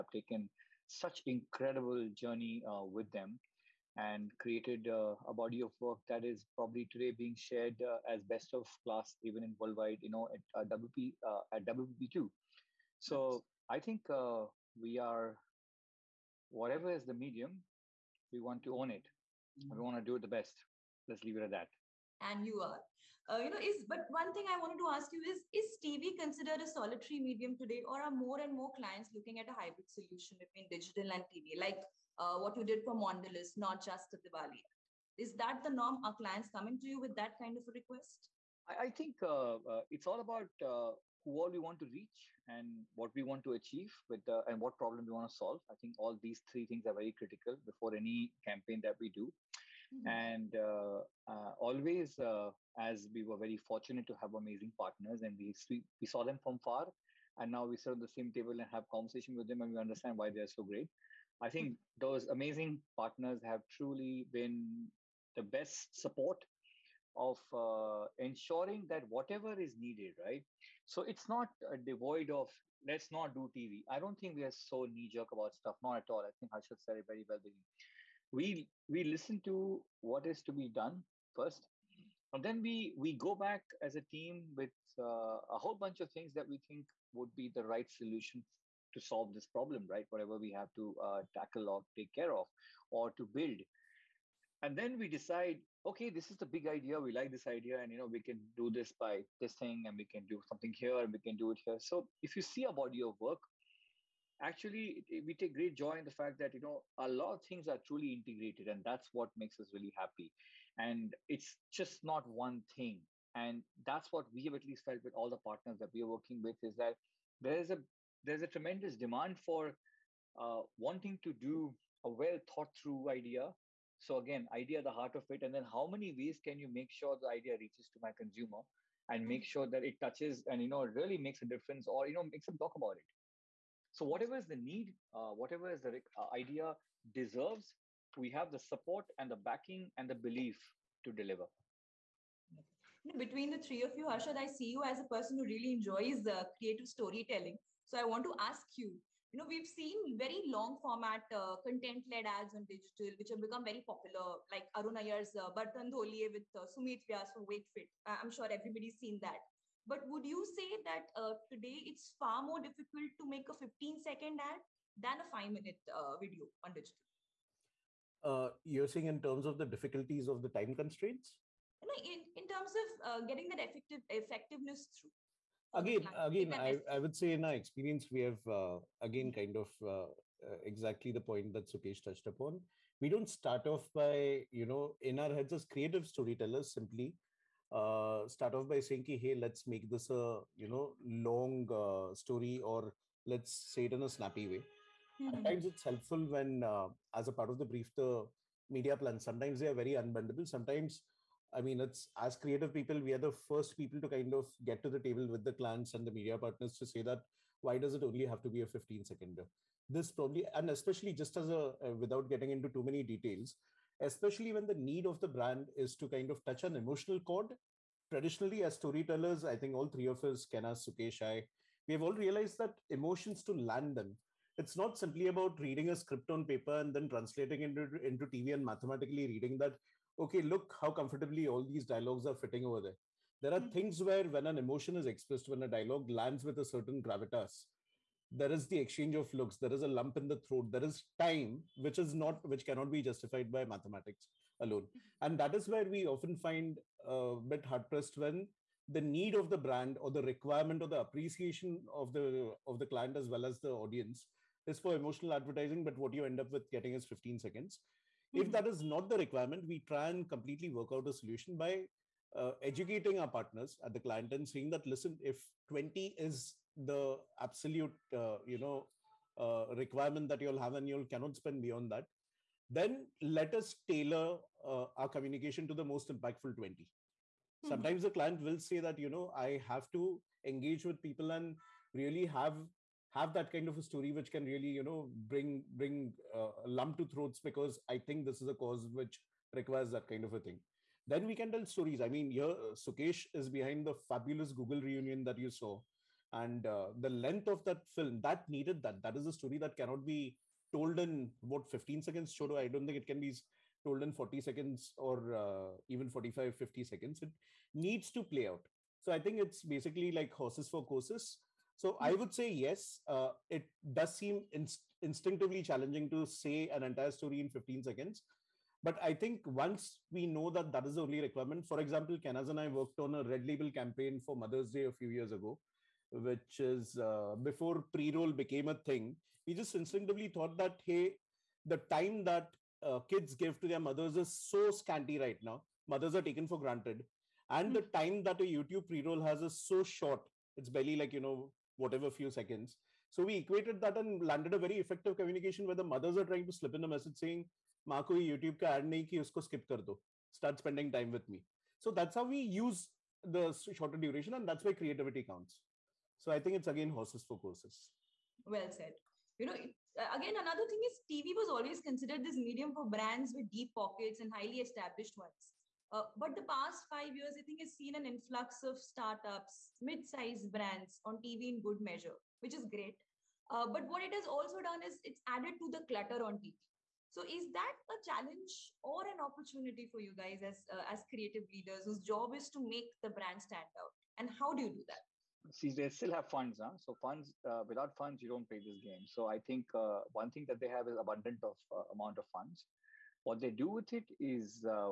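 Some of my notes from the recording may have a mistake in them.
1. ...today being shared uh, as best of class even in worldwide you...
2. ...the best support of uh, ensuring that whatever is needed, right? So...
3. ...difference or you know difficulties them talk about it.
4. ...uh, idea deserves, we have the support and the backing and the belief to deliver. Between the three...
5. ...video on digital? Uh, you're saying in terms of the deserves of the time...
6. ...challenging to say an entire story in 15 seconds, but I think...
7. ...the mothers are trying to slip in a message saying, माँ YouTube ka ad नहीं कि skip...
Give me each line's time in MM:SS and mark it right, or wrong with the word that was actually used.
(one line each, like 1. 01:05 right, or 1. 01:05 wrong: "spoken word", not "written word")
1. 00:06 right
2. 01:05 right
3. 02:11 wrong: "makes", not "difficulties"
4. 02:16 right
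5. 02:46 wrong: "difficulties", not "deserves"
6. 05:15 right
7. 05:45 right.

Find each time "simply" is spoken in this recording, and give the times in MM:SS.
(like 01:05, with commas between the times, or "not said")
03:06, 03:44.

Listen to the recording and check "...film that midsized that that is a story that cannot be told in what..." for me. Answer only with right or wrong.
wrong.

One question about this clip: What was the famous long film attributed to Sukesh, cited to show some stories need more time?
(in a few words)
Google Reunion.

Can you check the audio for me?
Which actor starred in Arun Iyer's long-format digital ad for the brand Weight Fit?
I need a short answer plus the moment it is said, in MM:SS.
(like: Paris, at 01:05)
Sumit Vyas, at 02:36.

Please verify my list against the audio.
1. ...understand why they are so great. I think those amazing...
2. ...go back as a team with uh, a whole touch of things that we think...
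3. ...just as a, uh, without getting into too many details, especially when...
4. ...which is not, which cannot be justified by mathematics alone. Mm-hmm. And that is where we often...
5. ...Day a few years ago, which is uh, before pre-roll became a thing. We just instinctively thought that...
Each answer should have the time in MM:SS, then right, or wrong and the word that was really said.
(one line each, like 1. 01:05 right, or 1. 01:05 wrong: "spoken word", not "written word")
1. 00:59 right
2. 01:23 wrong: "bunch", not "touch"
3. 03:31 right
4. 04:01 right
5. 05:24 right.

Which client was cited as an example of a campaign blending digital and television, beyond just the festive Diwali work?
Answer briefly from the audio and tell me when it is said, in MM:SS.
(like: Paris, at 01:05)
Mondelez, at 00:32.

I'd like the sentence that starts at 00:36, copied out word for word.
Are clients coming to you with that kind of a request?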